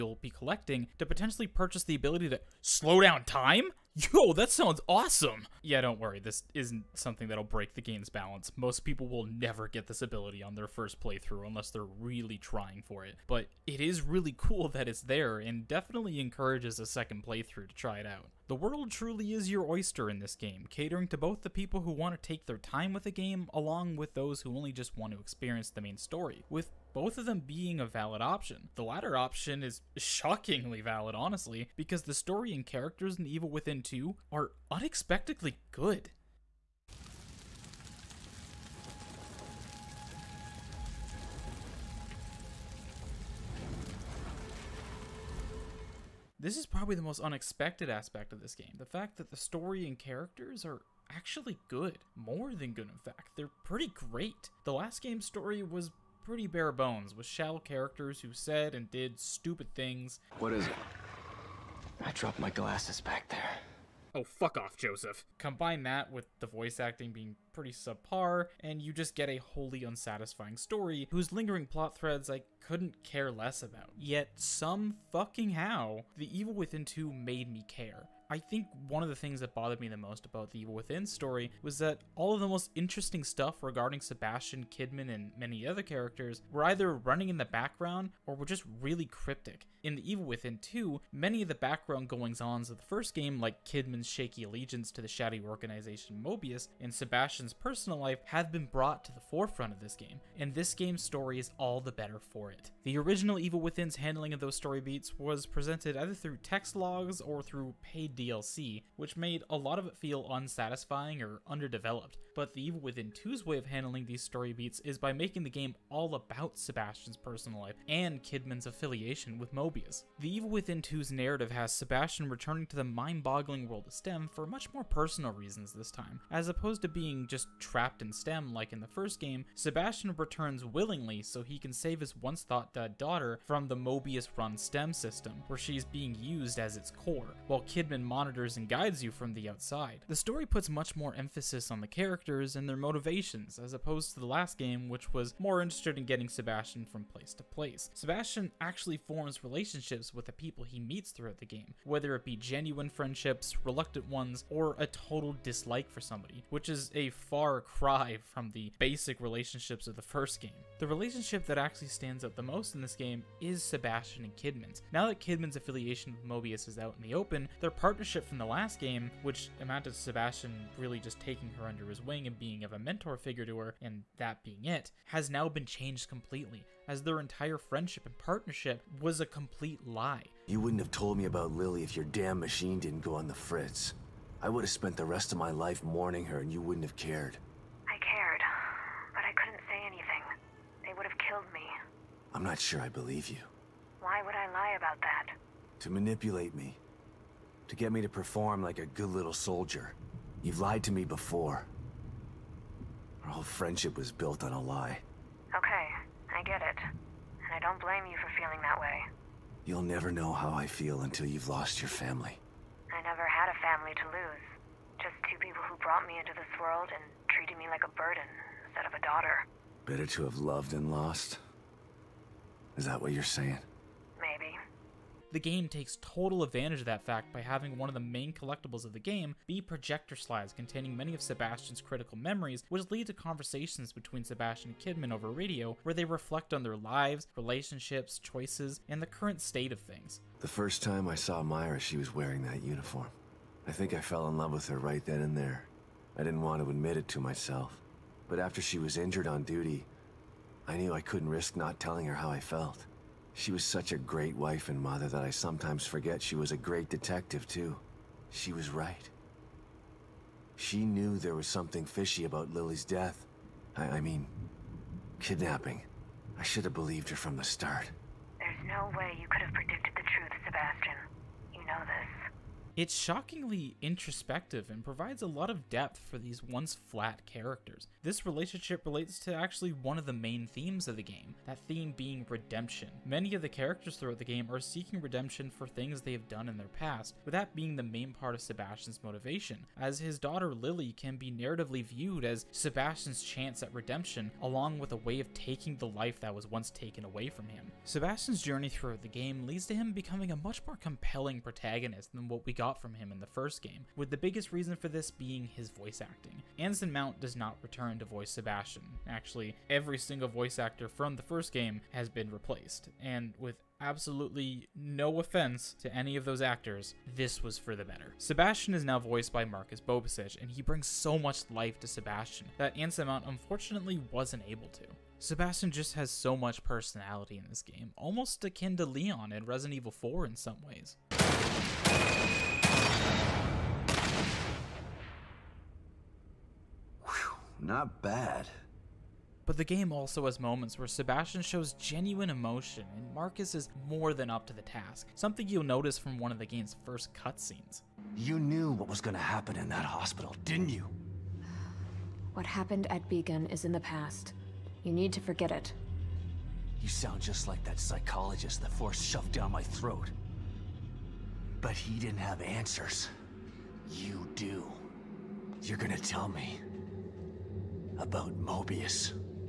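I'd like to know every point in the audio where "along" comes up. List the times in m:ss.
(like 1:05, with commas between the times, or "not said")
0:23, 4:54.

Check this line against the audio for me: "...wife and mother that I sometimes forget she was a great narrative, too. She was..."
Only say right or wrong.
wrong.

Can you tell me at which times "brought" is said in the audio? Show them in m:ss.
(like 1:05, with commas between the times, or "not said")
1:38, 3:35.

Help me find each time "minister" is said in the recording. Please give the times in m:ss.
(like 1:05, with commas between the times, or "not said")
not said.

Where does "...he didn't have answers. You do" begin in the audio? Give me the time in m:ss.
6:01.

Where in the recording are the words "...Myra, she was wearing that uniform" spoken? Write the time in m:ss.
4:01.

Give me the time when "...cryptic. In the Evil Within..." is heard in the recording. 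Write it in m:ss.
1:29.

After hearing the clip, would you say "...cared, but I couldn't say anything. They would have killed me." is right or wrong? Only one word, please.
right.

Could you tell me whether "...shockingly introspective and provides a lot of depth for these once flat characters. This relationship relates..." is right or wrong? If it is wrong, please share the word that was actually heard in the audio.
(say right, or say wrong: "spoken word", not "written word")
right.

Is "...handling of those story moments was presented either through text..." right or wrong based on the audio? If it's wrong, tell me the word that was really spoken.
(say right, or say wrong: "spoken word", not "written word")
wrong: "beats", not "moments".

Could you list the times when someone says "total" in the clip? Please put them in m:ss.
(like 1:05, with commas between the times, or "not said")
2:34, 3:45.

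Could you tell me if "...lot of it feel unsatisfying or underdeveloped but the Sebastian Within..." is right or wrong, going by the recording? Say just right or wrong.
wrong.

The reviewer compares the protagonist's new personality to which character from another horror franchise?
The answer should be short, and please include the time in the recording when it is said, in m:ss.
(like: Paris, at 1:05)
Leon, at 5:28.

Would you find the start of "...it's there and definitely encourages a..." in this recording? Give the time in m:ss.
0:14.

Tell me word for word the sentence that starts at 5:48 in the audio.
You knew what was going to happen in that hospital, didn't you?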